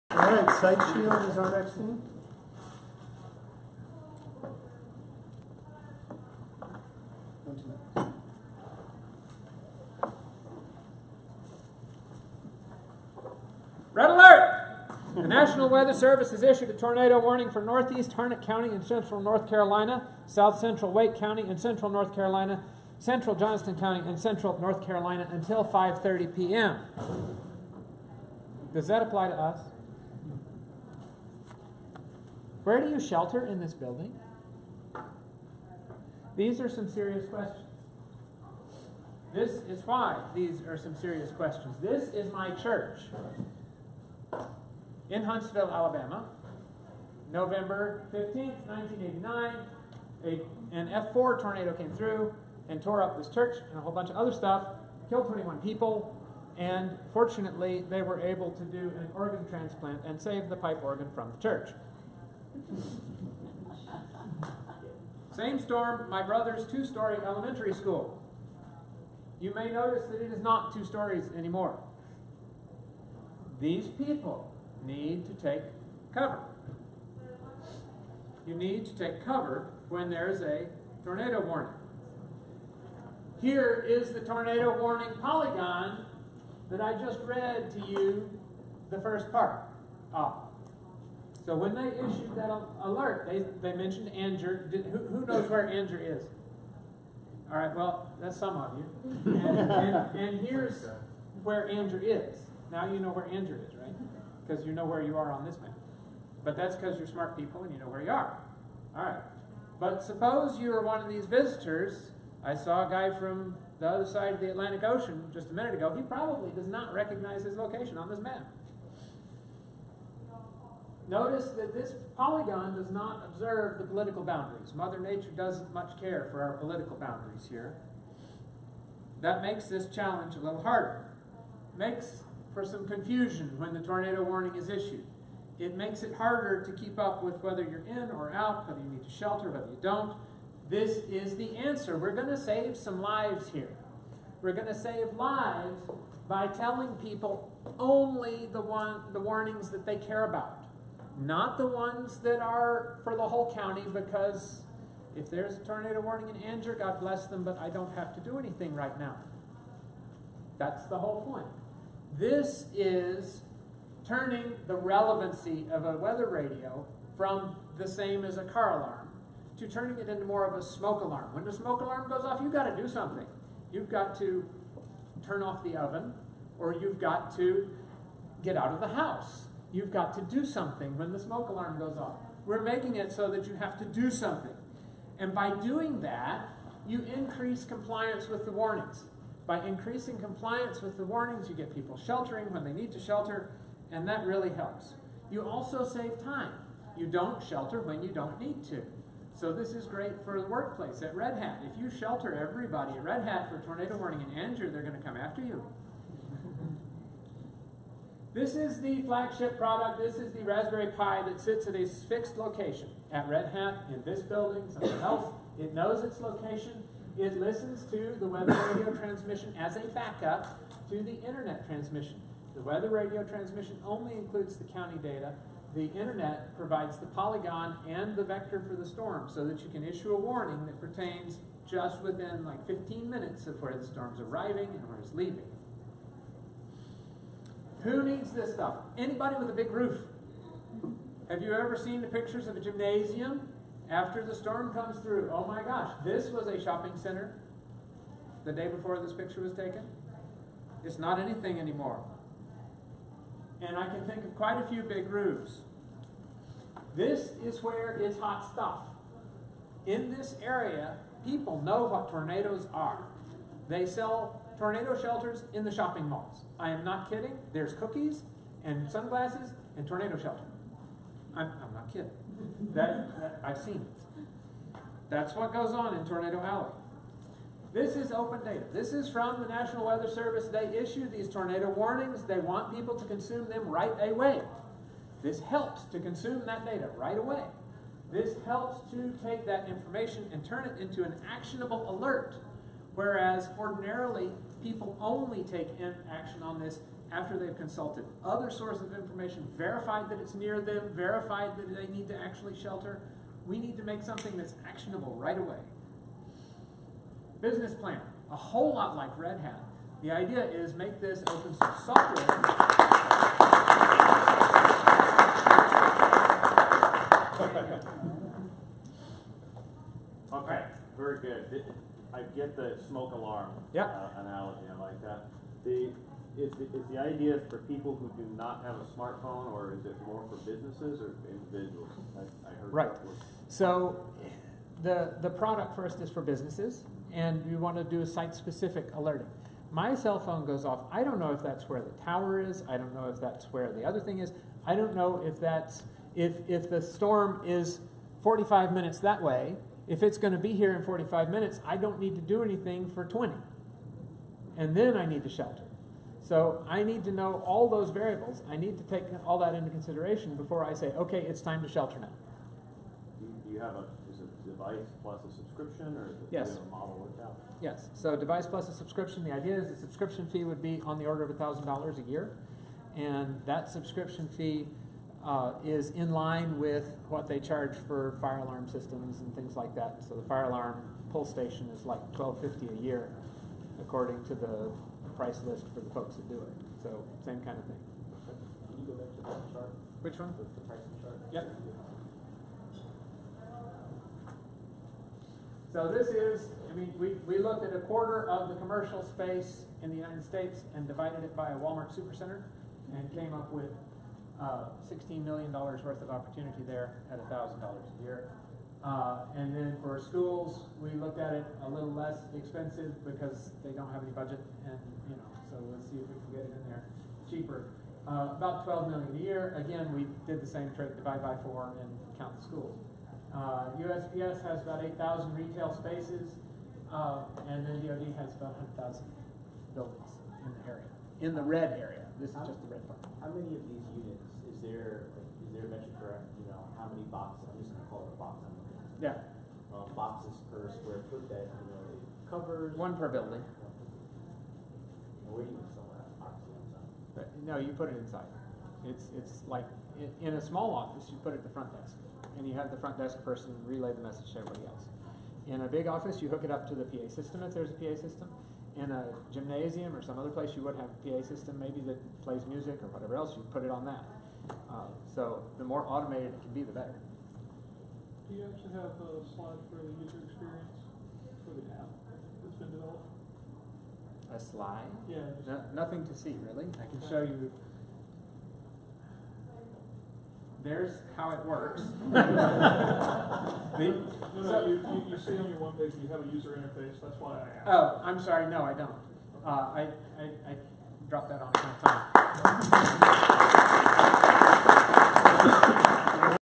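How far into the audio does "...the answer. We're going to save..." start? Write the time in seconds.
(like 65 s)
141 s.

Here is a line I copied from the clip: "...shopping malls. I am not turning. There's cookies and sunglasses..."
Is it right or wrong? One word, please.
wrong.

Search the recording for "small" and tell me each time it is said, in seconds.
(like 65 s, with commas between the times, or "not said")
450 s.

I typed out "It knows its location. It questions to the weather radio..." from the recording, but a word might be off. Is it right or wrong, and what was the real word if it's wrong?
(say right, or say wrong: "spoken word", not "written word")
wrong: "listens", not "questions".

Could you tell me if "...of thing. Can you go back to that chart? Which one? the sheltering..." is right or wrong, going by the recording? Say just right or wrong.
wrong.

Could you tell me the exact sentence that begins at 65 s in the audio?
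Same storm, my brother's two story elementary school.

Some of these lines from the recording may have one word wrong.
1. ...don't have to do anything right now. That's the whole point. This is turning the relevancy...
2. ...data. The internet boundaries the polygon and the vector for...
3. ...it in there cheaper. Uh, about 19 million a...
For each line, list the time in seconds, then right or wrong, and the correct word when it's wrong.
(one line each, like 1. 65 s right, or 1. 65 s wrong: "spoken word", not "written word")
1. 157 s right
2. 225 s wrong: "provides", not "boundaries"
3. 416 s wrong: "12", not "19".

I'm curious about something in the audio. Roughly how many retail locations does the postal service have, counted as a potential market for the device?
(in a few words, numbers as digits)
8,000.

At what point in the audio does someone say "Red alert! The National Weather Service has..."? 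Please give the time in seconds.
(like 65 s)
13 s.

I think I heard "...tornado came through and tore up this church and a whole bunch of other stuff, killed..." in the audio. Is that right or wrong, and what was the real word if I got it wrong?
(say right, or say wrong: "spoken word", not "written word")
right.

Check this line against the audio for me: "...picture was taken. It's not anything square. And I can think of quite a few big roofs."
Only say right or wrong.
wrong.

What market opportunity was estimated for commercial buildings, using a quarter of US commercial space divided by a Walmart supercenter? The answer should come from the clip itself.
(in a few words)
$16 million.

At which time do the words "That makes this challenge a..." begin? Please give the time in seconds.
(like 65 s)
129 s.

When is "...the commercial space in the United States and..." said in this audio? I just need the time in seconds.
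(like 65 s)
398 s.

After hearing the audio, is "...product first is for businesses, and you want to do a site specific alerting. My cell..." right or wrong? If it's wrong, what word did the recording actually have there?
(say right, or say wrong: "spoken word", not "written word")
right.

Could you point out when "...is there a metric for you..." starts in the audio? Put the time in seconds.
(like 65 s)
435 s.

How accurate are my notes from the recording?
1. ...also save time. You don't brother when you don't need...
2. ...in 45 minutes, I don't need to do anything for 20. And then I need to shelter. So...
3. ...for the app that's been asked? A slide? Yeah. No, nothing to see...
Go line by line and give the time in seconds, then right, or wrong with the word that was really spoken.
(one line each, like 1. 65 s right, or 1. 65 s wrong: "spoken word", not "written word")
1. 195 s wrong: "shelter", not "brother"
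2. 350 s right
3. 471 s wrong: "developed", not "asked".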